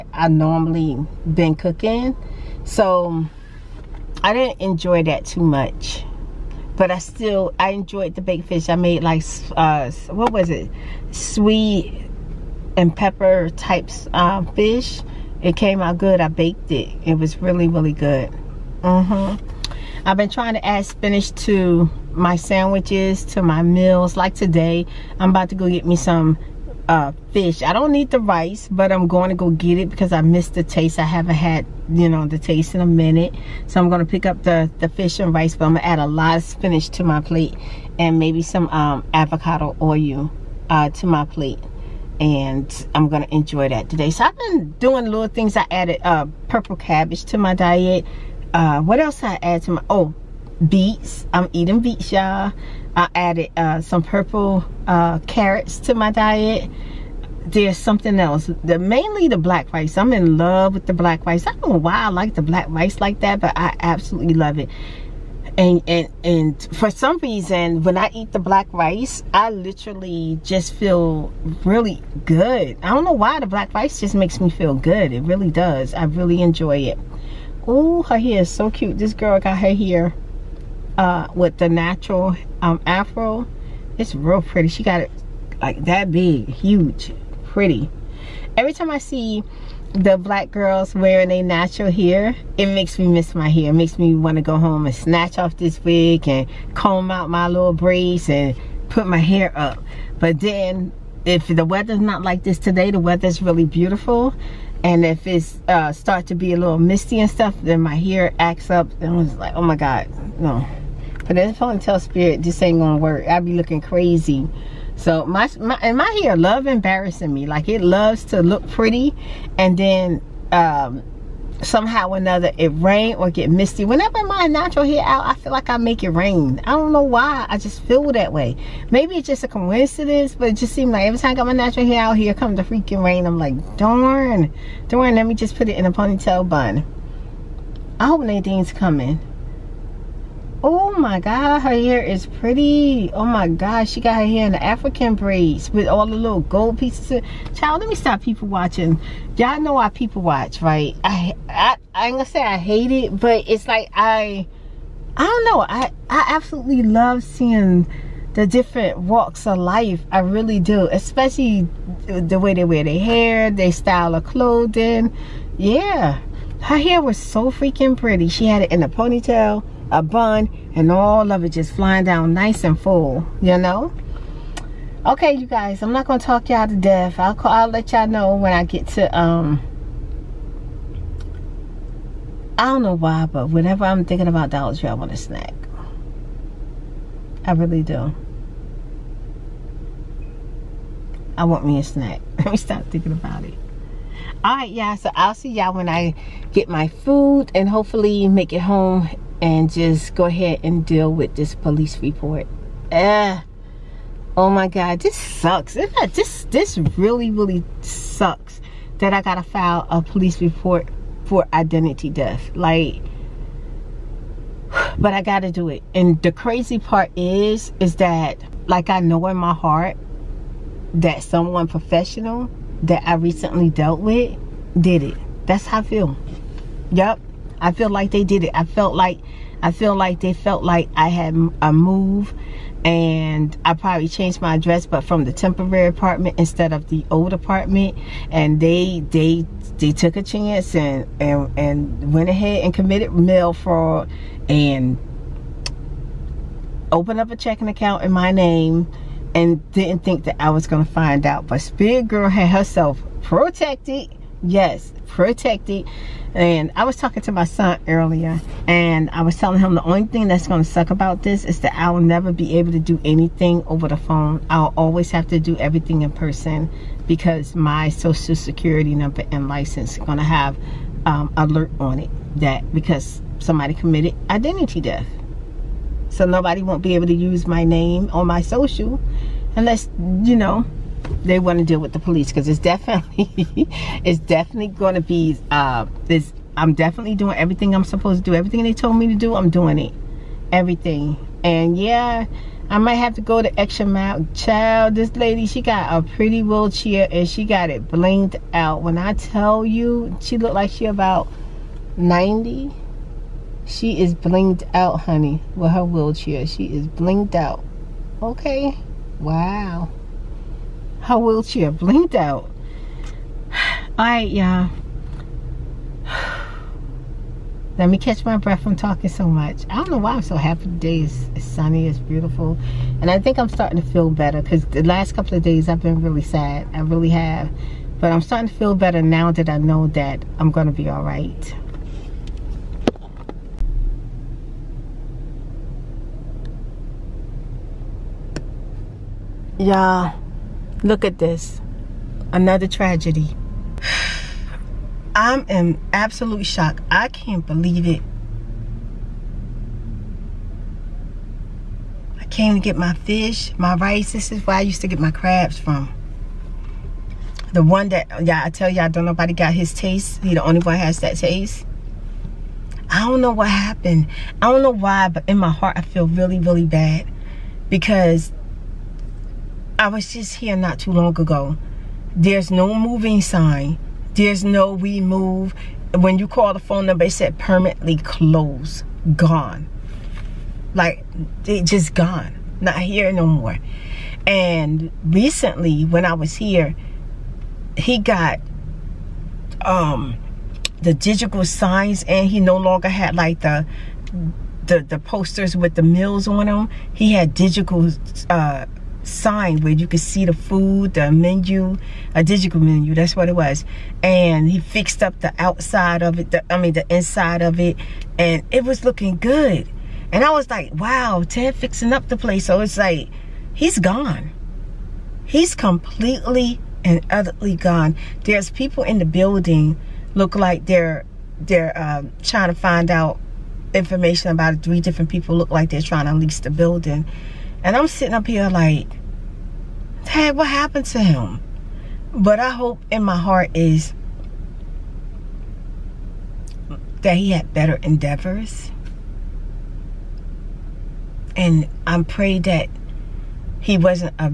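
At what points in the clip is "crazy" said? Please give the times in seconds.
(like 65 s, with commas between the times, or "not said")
113 s, 216 s.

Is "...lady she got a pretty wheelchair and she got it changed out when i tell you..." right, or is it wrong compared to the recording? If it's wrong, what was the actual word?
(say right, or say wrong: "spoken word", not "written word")
wrong: "blinged", not "changed".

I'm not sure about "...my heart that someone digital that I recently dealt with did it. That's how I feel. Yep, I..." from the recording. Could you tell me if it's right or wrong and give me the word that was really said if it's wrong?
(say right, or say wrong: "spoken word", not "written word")
wrong: "professional", not "digital".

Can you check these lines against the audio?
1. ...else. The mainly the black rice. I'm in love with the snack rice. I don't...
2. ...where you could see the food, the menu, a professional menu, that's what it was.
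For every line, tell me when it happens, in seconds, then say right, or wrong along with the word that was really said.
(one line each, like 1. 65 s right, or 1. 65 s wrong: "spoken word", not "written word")
1. 58 s wrong: "black", not "snack"
2. 399 s wrong: "digital", not "professional".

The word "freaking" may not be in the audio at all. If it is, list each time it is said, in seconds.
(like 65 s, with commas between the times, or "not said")
132 s, 167 s.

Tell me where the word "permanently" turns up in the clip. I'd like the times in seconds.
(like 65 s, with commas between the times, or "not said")
377 s.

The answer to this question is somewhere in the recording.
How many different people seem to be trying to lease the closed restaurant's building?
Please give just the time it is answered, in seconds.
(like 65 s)
424 s.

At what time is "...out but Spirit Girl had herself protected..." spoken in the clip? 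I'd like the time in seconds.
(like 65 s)
251 s.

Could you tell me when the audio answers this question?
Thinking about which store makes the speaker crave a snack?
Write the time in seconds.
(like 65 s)
184 s.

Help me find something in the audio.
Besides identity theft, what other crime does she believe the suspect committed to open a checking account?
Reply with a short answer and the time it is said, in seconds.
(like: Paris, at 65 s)
mail fraud, at 243 s.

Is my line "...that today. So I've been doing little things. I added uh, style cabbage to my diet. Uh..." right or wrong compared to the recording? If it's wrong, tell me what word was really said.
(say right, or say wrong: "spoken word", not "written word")
wrong: "purple", not "style".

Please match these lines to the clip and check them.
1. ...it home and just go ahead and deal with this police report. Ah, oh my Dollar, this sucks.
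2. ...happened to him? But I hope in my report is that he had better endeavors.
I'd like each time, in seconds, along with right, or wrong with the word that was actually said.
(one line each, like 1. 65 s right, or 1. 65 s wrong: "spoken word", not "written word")
1. 198 s wrong: "God", not "Dollar"
2. 430 s wrong: "heart", not "report".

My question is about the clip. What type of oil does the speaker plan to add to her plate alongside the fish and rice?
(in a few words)
avocado oil.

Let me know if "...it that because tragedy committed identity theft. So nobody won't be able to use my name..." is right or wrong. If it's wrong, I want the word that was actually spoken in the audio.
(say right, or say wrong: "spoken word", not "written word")
wrong: "somebody", not "tragedy".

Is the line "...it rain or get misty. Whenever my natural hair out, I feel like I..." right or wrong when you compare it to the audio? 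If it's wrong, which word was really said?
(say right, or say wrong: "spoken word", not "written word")
right.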